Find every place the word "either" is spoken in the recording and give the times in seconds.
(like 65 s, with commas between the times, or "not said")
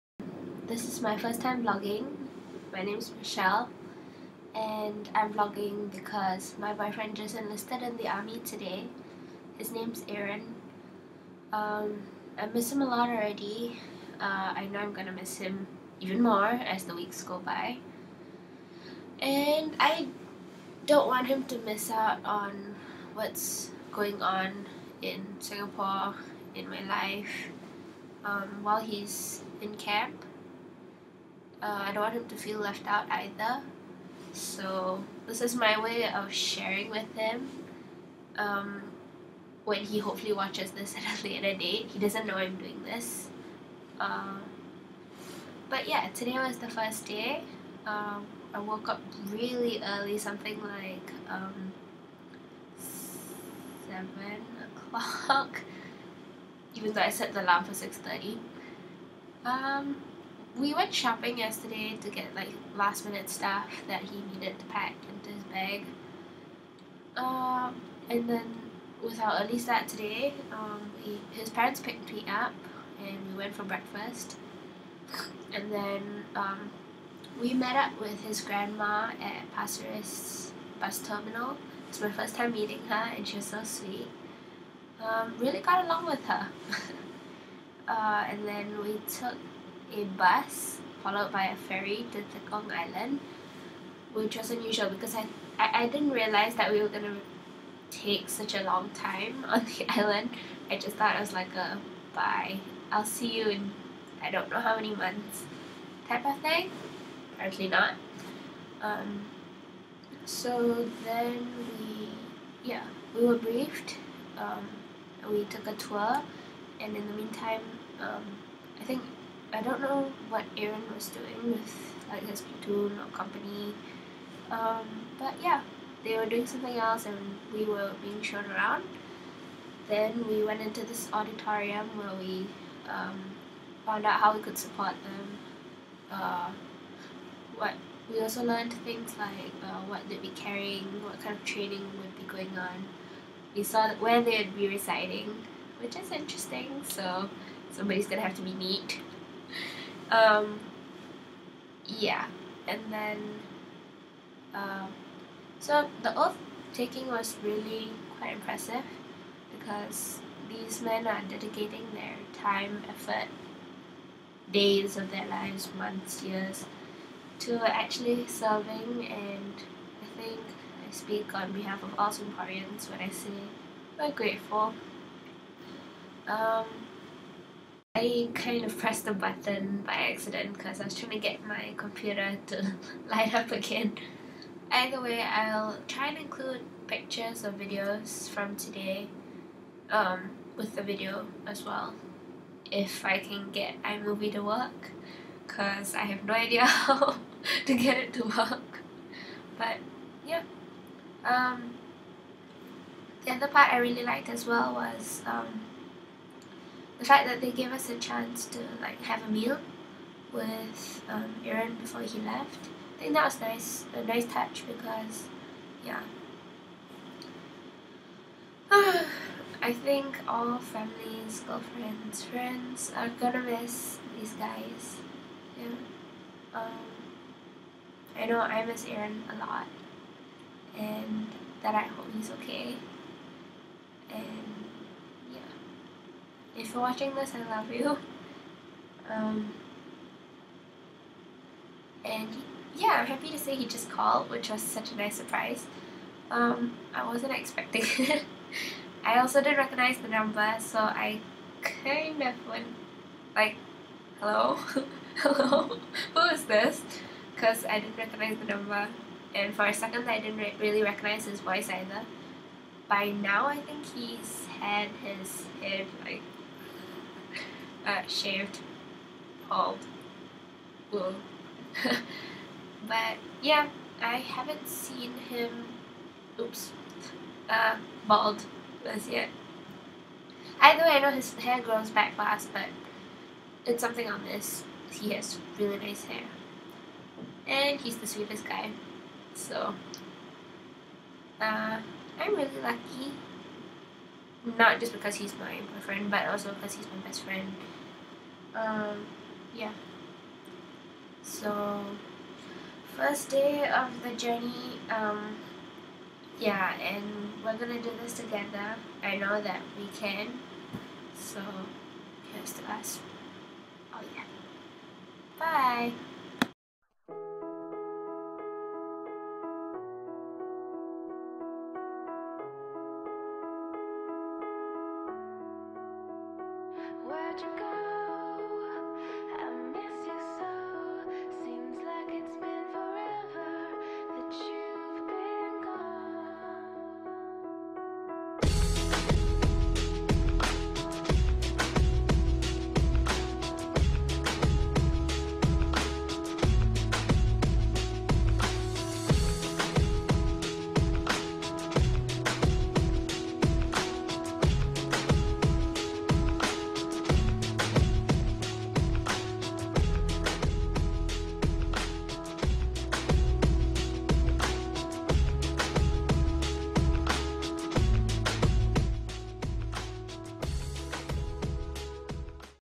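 33 s, 184 s, 261 s.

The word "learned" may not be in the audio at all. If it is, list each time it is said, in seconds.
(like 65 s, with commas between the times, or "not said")
138 s.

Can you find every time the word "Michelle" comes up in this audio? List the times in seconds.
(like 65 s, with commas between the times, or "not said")
3 s.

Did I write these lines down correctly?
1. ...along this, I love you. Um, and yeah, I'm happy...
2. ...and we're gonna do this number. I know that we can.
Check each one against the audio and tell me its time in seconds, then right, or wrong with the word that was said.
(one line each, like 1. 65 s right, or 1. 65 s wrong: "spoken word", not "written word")
1. 236 s wrong: "watching", not "along"
2. 306 s wrong: "together", not "number".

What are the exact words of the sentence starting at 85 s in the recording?
Um, really got along with her.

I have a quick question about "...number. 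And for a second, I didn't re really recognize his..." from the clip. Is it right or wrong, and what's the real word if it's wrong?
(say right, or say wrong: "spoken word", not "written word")
right.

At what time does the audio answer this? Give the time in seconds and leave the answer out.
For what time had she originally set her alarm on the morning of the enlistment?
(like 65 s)
57 s.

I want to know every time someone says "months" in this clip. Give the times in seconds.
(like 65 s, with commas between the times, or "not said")
104 s, 165 s.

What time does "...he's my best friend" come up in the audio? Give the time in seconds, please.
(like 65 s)
296 s.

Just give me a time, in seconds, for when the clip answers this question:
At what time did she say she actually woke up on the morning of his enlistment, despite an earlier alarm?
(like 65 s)
53 s.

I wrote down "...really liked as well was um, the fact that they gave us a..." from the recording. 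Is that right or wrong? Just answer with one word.
right.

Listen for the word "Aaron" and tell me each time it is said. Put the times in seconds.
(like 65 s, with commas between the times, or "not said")
10 s, 120 s, 211 s, 228 s.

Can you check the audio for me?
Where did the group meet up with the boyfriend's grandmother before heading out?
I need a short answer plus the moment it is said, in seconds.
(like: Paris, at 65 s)
Pasir Ris bus terminal, at 79 s.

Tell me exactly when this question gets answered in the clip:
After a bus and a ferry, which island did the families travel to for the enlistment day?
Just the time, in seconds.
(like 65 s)
92 s.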